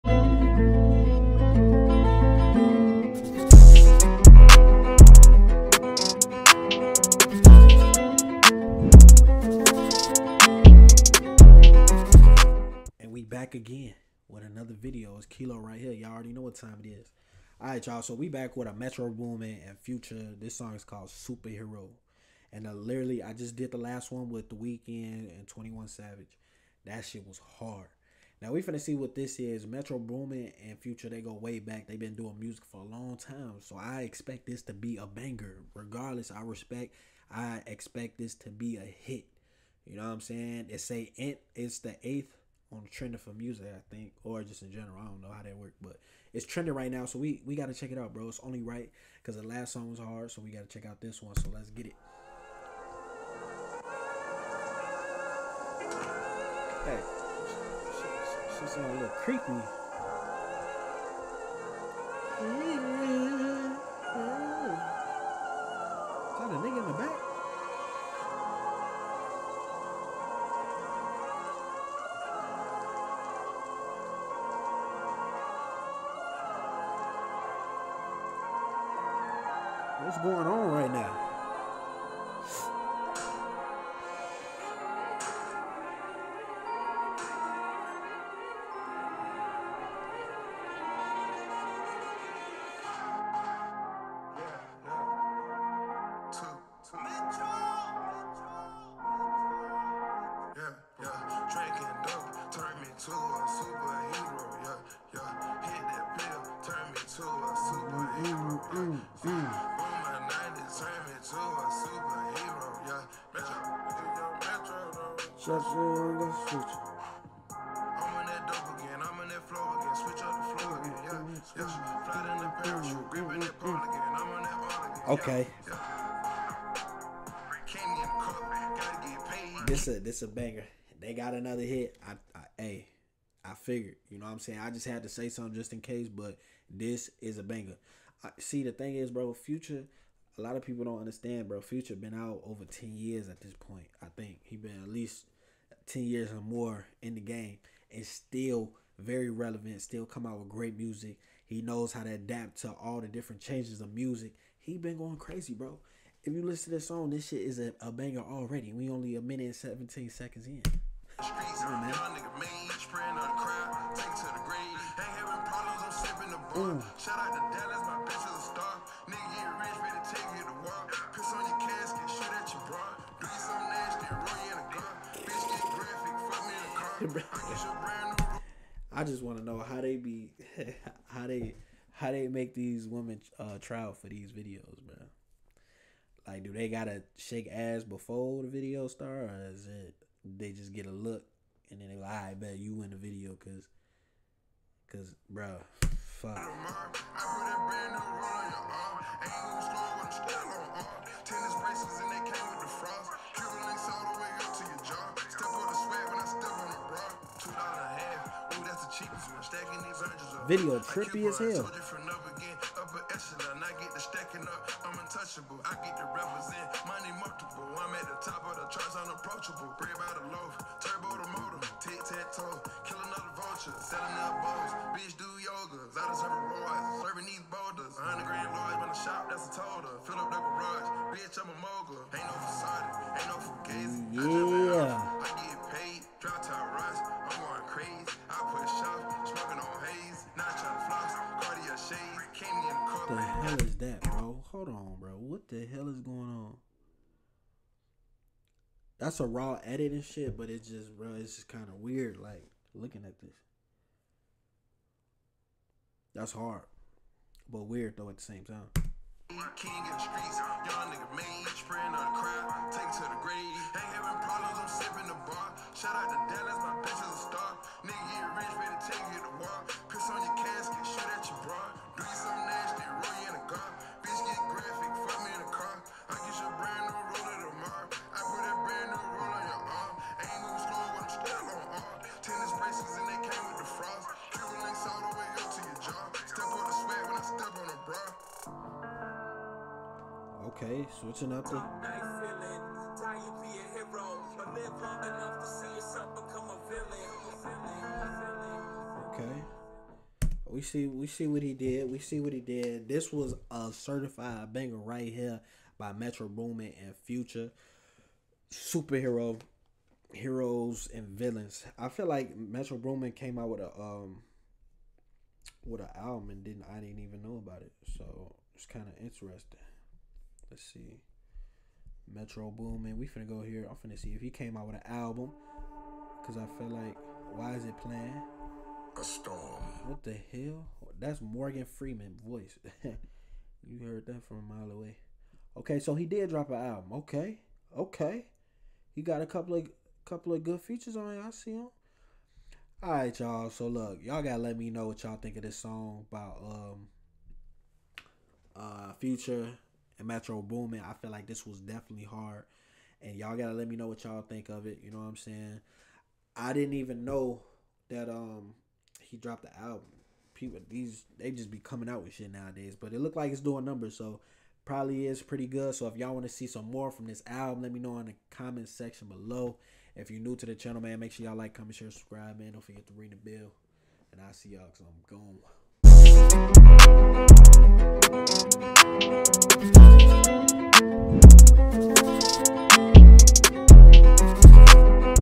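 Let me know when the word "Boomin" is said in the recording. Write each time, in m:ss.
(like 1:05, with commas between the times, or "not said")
0:19, 0:29, 5:06, 5:12, 5:22, 5:50.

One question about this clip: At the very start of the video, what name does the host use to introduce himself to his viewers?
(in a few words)
Kilo.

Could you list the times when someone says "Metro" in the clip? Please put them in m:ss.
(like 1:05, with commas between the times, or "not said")
0:18, 0:29, 5:05, 5:12, 5:22, 5:50.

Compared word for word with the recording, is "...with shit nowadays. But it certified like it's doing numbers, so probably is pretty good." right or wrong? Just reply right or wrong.
wrong.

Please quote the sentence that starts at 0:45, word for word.
I don't know how that worked, but it's trending right now, so we we gotta check it out, bro.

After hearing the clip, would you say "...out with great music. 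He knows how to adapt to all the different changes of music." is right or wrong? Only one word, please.
right.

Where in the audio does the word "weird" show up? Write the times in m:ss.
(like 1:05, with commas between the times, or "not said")
4:11, 4:17.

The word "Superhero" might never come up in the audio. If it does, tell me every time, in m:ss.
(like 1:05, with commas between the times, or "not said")
0:21, 5:08.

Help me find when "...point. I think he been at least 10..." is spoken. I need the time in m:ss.
2:23.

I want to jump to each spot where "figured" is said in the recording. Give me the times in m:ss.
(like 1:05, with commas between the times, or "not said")
2:13.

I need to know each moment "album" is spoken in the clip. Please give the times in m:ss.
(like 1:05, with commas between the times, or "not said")
5:15, 5:24, 5:36, 5:59, 6:07.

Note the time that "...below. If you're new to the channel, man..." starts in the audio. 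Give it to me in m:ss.
6:09.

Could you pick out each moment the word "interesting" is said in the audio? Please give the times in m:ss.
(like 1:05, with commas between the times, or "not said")
5:19.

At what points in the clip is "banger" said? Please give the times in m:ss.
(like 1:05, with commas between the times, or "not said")
0:35, 2:10, 2:17, 2:37, 5:04.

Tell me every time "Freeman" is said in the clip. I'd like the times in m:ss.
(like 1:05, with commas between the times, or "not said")
5:31.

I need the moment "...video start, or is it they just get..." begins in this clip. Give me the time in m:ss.
3:08.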